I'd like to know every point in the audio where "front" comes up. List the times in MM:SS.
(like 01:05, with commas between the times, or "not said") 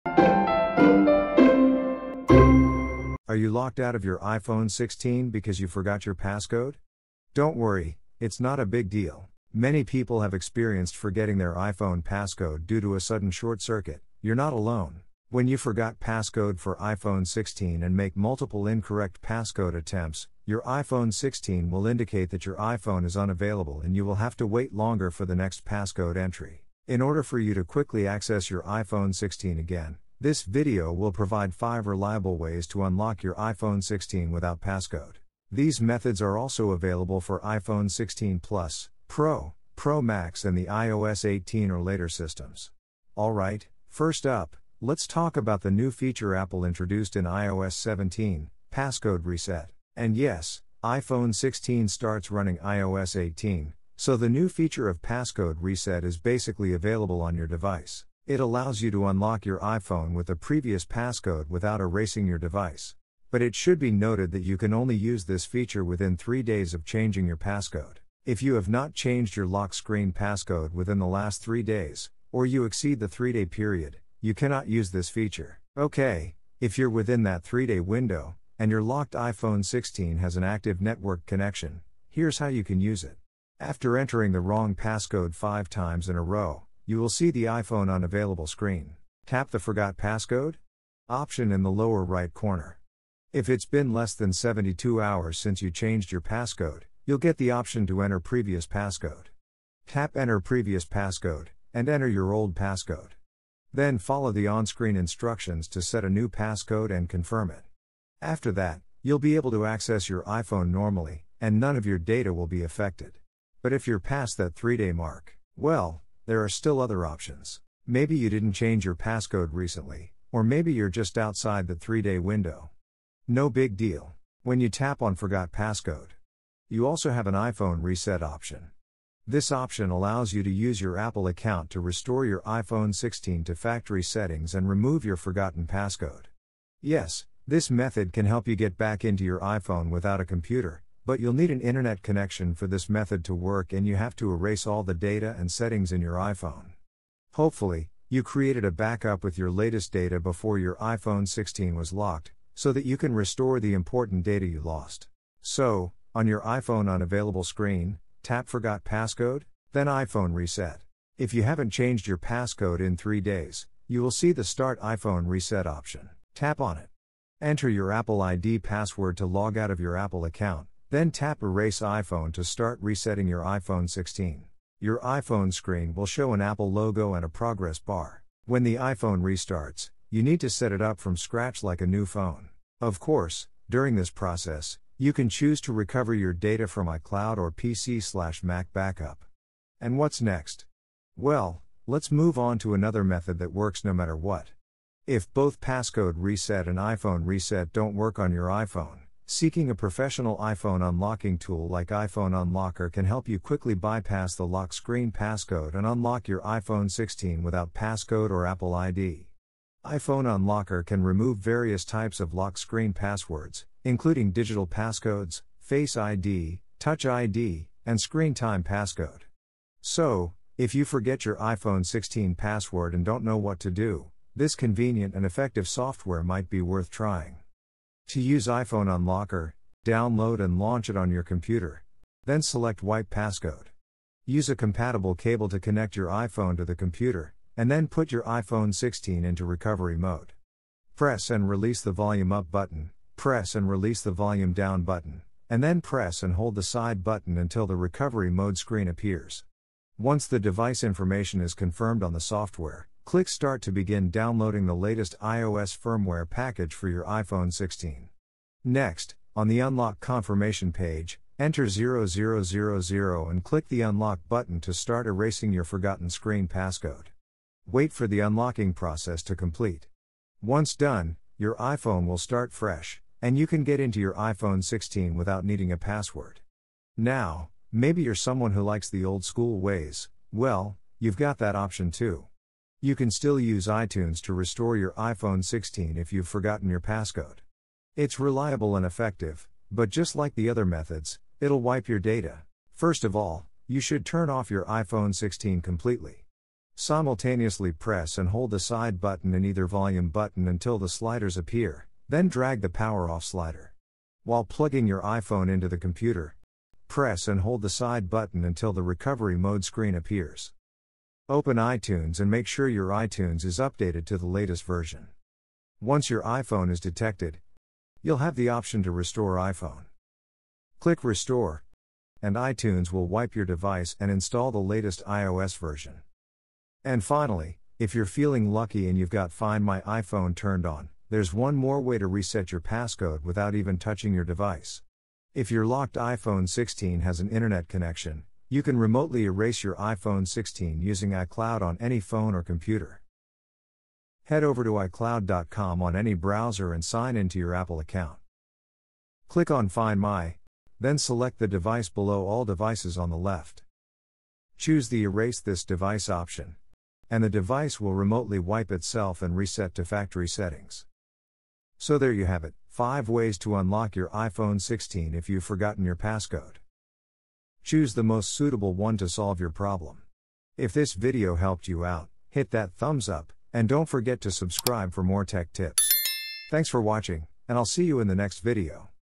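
not said.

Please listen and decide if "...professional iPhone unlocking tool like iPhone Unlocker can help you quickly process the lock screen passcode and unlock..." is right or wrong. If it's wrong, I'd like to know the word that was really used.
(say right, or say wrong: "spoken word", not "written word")
wrong: "bypass", not "process".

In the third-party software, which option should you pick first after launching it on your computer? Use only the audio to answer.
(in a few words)
Wipe Passcode.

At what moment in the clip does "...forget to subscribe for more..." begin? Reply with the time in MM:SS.
06:13.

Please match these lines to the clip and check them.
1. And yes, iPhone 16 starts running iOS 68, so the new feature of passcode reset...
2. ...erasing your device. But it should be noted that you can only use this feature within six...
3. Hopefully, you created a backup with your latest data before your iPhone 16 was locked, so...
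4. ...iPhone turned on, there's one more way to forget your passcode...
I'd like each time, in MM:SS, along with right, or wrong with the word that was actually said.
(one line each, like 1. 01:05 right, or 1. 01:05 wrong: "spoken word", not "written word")
1. 00:49 wrong: "18", not "68"
2. 01:01 wrong: "three", not "six"
3. 02:27 right
4. 05:30 wrong: "reset", not "forget".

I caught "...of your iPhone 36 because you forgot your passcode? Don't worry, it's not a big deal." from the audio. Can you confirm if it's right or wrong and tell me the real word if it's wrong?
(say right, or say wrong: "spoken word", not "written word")
wrong: "16", not "36".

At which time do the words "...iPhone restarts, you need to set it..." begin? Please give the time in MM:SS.
02:58.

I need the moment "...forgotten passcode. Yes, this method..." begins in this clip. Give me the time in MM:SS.
02:15.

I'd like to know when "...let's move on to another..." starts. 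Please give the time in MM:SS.
03:11.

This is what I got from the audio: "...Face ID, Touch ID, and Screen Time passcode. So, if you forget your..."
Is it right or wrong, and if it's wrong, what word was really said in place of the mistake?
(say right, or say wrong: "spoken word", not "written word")
right.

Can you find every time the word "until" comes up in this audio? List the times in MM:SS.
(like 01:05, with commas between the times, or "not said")
04:07, 05:00, 05:08.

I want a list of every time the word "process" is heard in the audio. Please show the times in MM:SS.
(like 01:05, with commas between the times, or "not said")
03:04, 04:28.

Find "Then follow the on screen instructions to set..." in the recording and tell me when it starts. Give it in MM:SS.
01:43.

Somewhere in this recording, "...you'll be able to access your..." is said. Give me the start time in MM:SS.
01:49.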